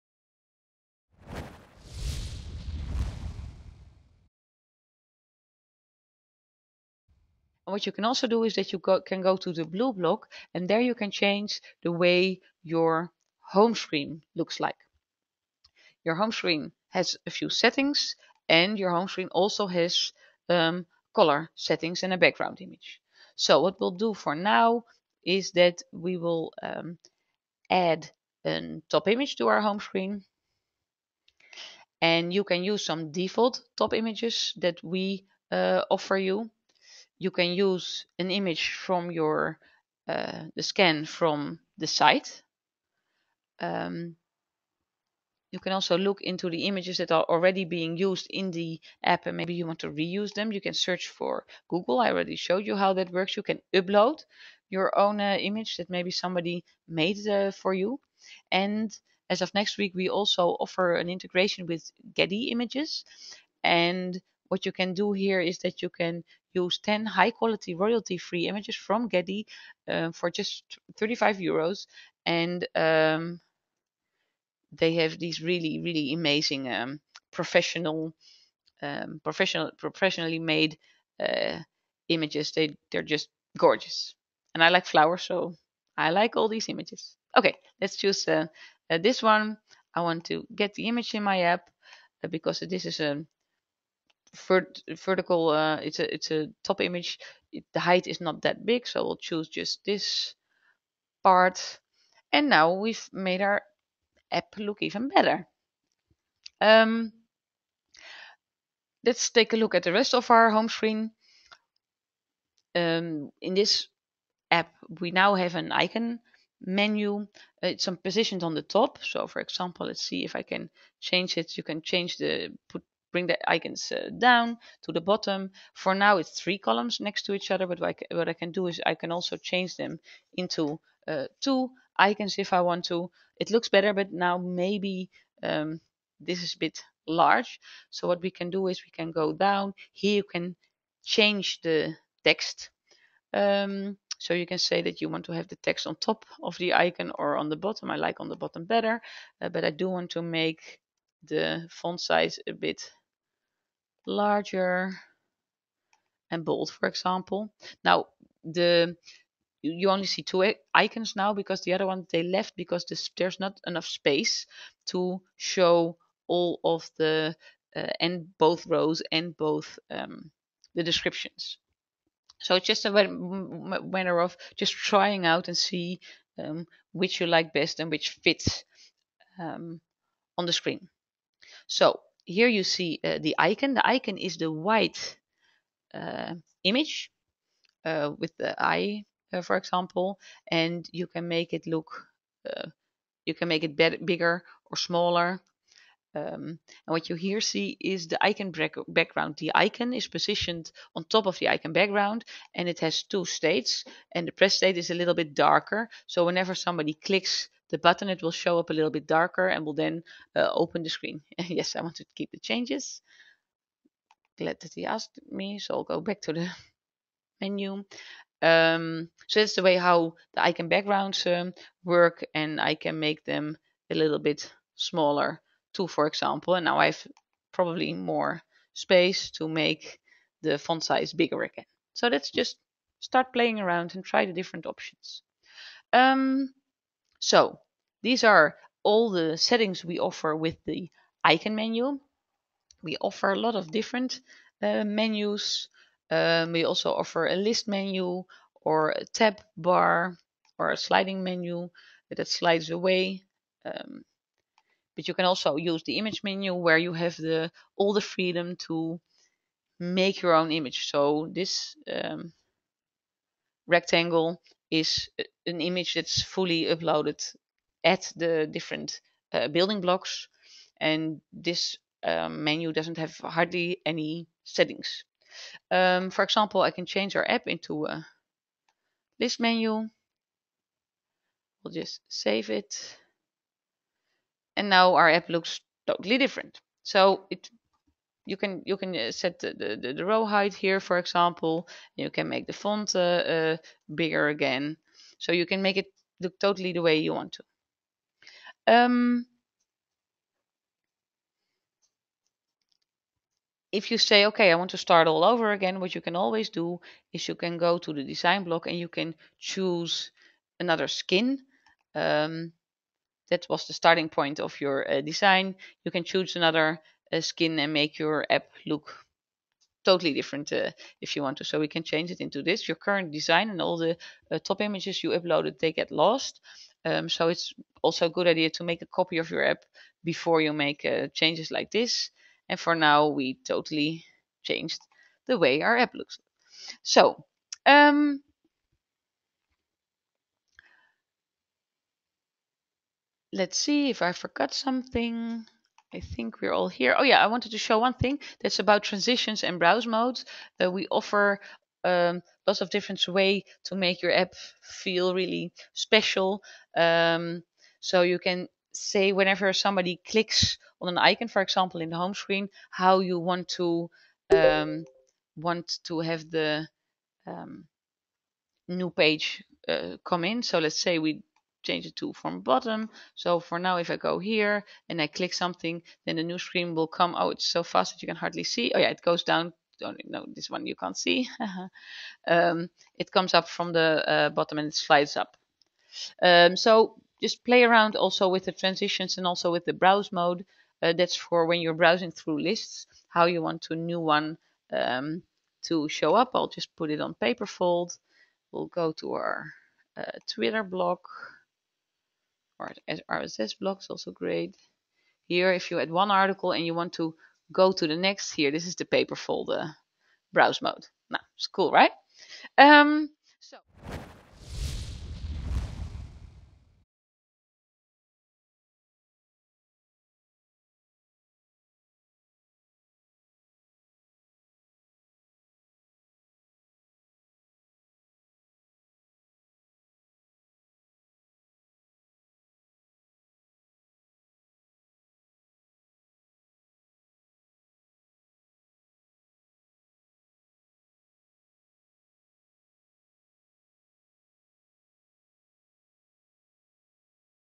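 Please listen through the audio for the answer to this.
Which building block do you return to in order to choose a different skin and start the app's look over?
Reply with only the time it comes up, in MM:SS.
05:08.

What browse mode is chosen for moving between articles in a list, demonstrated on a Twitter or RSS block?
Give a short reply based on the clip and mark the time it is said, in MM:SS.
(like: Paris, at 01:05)
Paper fold, at 06:37.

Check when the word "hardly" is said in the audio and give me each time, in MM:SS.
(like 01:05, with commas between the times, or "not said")
04:33, 06:18.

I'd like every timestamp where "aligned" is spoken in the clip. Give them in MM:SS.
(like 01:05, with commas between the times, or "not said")
not said.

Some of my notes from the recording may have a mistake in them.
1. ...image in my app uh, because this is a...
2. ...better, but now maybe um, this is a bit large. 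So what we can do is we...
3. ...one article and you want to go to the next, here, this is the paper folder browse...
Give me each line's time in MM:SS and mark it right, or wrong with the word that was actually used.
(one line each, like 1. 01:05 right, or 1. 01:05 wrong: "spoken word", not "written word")
1. 01:30 right
2. 02:13 right
3. 06:45 right.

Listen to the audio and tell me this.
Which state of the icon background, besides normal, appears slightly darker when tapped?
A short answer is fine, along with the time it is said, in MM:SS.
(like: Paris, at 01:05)
Press state, at 03:24.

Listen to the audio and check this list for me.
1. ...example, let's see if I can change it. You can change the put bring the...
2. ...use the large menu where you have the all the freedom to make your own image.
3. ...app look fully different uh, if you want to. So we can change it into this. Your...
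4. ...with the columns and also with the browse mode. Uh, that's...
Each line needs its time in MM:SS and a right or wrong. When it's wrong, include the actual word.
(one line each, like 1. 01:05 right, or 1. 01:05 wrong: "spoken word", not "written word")
1. 01:59 right
2. 04:15 wrong: "image", not "large"
3. 05:18 wrong: "totally", not "fully"
4. 06:28 wrong: "transitions", not "columns".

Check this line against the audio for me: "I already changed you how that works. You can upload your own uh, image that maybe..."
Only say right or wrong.
wrong.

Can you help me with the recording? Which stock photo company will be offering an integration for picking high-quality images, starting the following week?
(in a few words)
Getty Images.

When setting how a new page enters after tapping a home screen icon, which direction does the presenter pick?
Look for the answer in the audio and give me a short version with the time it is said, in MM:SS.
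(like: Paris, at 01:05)
From bottom, at 06:12.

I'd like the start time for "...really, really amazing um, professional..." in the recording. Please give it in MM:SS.
01:15.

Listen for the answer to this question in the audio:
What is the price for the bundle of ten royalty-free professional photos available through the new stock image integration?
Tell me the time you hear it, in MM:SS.
01:10.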